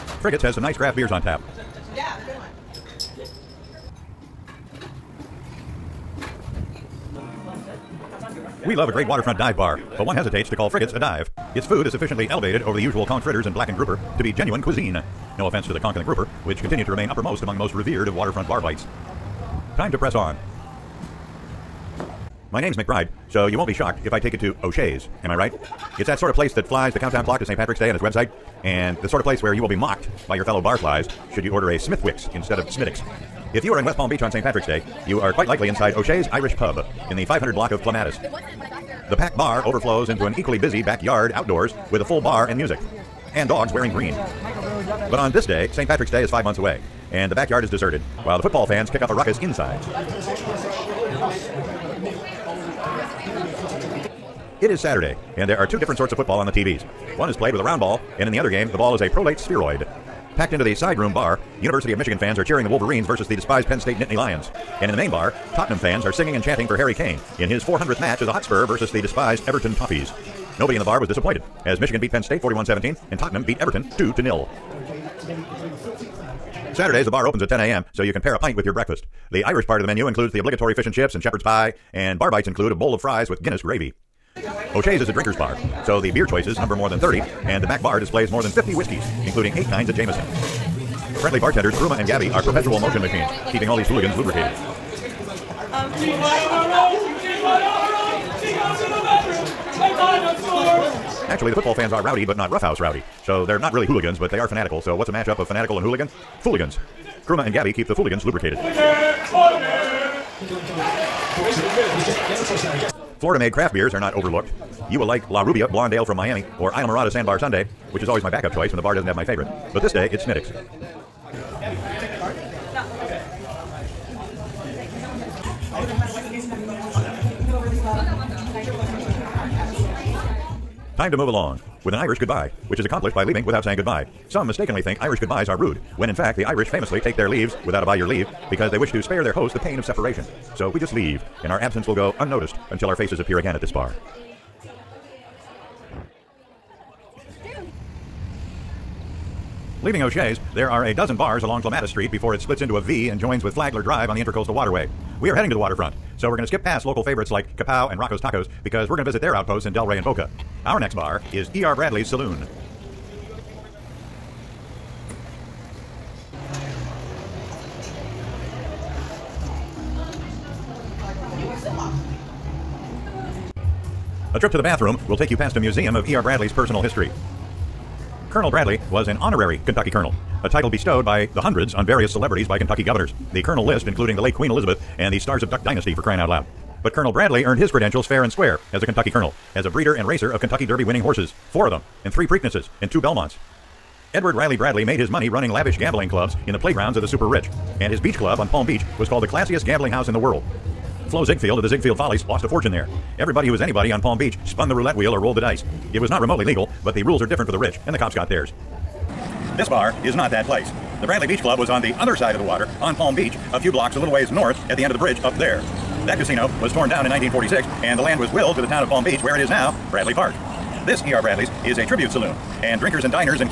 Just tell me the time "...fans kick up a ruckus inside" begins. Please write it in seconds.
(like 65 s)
48 s.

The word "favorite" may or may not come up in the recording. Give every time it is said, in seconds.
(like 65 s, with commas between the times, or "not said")
119 s, 157 s.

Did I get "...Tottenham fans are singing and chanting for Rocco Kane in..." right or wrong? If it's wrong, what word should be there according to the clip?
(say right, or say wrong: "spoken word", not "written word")
wrong: "Harry", not "Rocco".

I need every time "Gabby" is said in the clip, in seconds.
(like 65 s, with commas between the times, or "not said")
92 s, 107 s.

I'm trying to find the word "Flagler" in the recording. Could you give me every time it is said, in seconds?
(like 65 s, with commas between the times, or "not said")
153 s.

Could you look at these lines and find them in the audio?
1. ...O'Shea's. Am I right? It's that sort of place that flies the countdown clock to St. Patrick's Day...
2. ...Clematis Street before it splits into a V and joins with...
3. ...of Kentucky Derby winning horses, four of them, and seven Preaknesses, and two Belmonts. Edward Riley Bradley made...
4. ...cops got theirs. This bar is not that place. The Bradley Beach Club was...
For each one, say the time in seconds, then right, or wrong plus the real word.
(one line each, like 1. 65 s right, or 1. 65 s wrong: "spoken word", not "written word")
1. 24 s right
2. 151 s right
3. 190 s wrong: "three", not "seven"
4. 207 s right.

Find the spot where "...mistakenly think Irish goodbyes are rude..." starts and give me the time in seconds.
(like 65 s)
134 s.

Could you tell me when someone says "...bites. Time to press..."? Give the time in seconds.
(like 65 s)
18 s.